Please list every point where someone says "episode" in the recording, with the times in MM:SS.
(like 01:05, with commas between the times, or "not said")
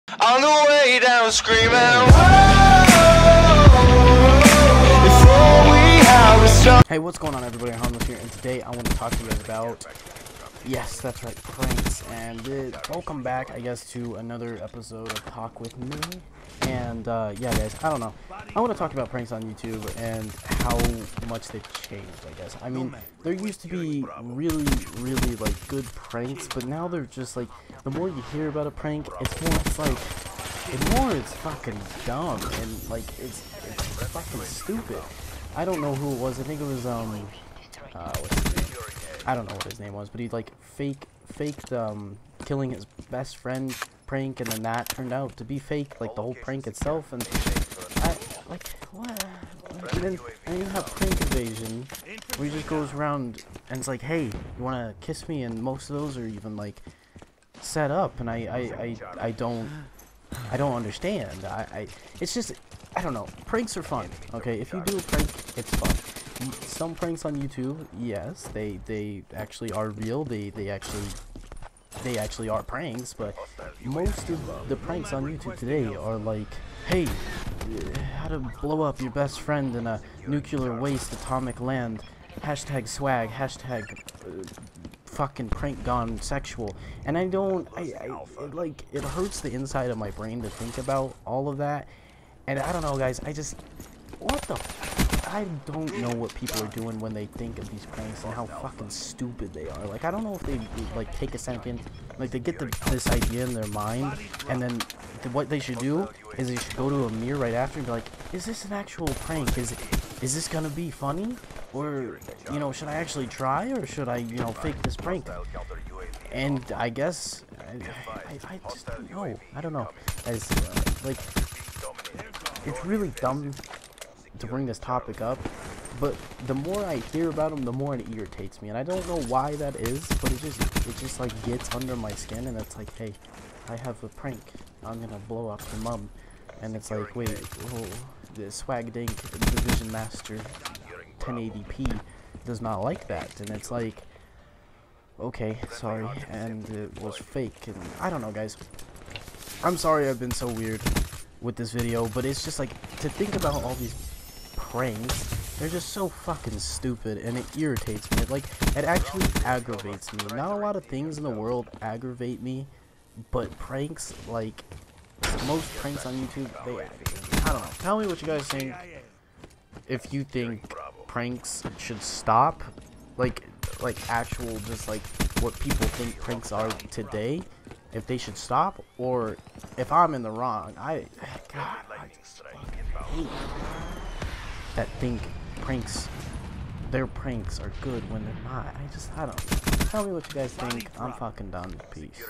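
00:14.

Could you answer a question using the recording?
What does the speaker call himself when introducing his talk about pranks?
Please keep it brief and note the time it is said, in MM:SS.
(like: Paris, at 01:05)
Harmless, at 00:07.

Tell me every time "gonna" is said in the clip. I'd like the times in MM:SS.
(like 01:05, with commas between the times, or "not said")
01:50, 02:14.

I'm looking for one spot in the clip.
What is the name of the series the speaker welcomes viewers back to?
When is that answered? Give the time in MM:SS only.
00:15.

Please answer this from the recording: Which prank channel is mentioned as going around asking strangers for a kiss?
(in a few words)
Prank Invasion.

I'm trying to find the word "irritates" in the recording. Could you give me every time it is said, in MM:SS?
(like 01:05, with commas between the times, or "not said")
02:08, 02:37.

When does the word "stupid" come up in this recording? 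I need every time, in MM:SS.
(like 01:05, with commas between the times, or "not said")
00:34, 01:38, 02:36.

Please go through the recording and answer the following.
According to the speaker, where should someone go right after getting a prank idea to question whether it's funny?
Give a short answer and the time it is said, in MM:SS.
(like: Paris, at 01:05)
a mirror, at 01:47.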